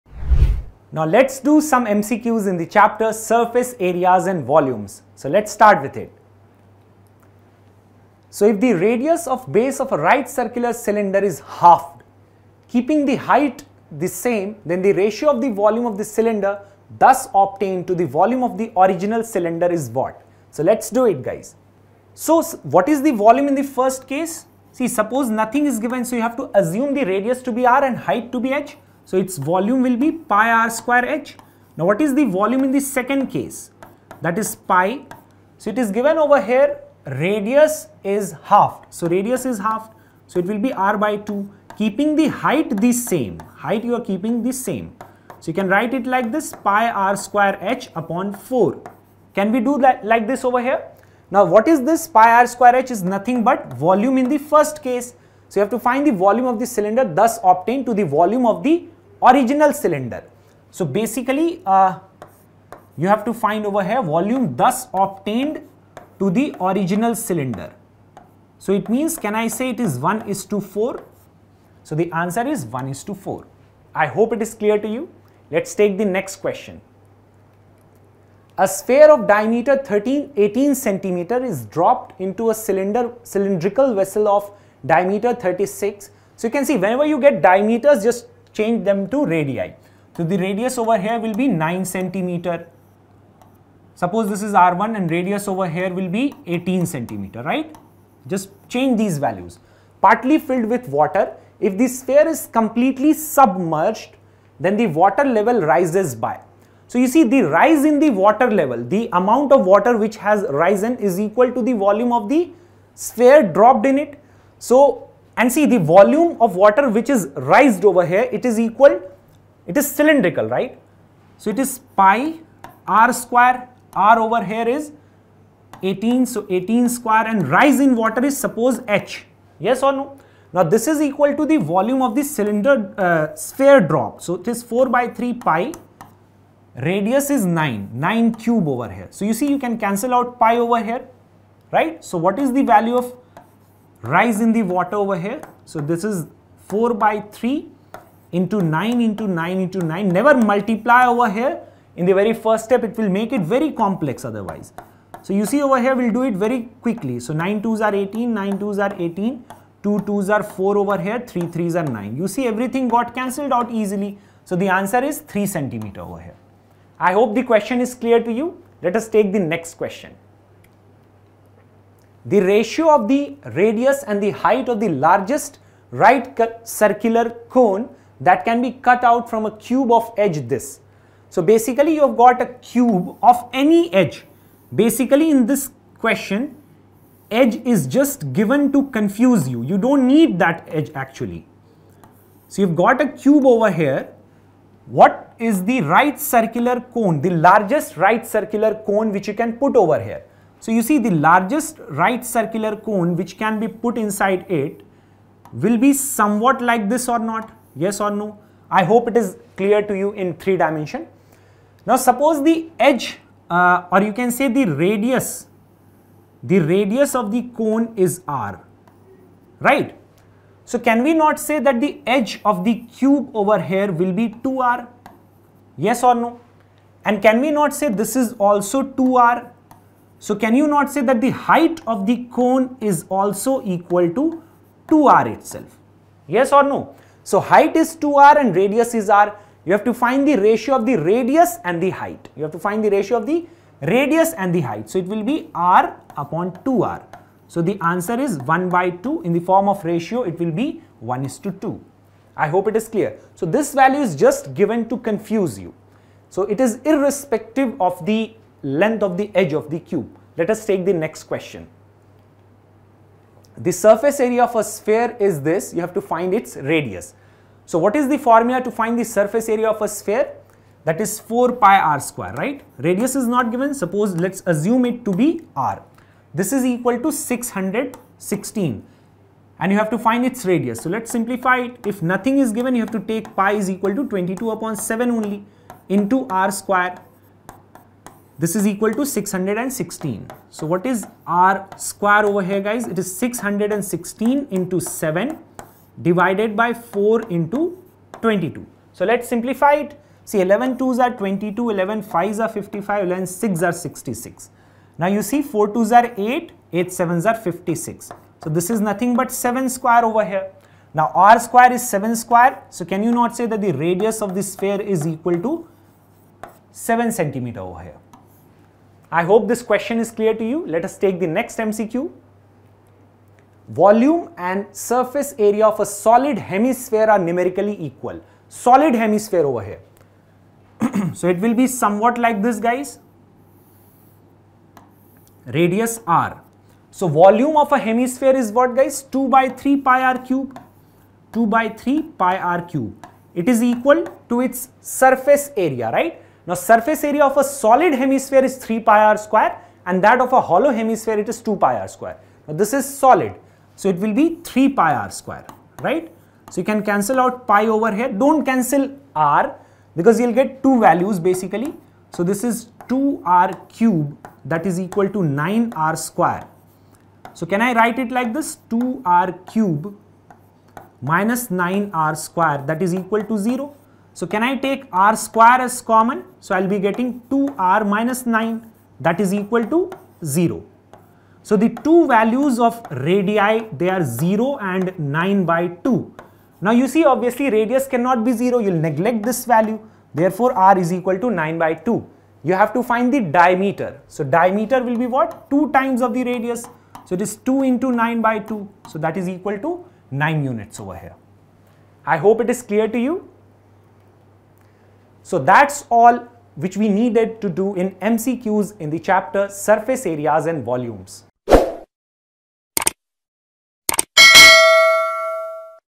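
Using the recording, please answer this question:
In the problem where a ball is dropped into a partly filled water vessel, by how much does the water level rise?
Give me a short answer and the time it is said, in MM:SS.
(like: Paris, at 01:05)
3 centimeters, at 02:45.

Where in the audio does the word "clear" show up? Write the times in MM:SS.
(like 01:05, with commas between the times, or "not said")
01:14, 02:47, 03:29, 04:12, 05:20, 06:42.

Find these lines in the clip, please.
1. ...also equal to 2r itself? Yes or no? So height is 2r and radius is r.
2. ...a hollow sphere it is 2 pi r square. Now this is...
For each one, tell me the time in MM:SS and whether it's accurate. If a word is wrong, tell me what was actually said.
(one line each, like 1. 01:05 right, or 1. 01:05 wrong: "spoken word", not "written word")
1. 03:53 right
2. 05:50 wrong: "hemisphere", not "sphere".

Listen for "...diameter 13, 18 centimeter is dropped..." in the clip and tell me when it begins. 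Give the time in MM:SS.
01:19.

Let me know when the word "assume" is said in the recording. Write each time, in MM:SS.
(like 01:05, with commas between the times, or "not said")
00:26, 04:34.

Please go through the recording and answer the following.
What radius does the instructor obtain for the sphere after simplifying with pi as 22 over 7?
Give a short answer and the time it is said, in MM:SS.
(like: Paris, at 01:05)
7 centimeters, at 05:16.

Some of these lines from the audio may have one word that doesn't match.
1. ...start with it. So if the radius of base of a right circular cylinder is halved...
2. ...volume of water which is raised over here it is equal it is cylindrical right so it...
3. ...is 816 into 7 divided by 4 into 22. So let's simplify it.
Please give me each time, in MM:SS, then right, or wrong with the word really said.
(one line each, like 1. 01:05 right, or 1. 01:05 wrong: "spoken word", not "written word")
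1. 00:05 right
2. 01:55 right
3. 04:53 wrong: "616", not "816".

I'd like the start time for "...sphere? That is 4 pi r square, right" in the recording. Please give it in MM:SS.
04:29.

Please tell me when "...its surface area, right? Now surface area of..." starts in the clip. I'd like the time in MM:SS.
05:44.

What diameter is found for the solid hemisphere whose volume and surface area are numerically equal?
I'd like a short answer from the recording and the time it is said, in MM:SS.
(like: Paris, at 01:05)
9 units, at 06:40.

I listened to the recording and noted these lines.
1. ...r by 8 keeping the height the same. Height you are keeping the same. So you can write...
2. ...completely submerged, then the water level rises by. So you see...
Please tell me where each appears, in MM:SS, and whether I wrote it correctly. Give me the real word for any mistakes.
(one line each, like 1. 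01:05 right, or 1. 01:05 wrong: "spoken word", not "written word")
1. 00:40 wrong: "2", not "8"
2. 01:42 right.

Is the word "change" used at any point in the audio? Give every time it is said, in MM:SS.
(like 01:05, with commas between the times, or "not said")
01:28, 01:38.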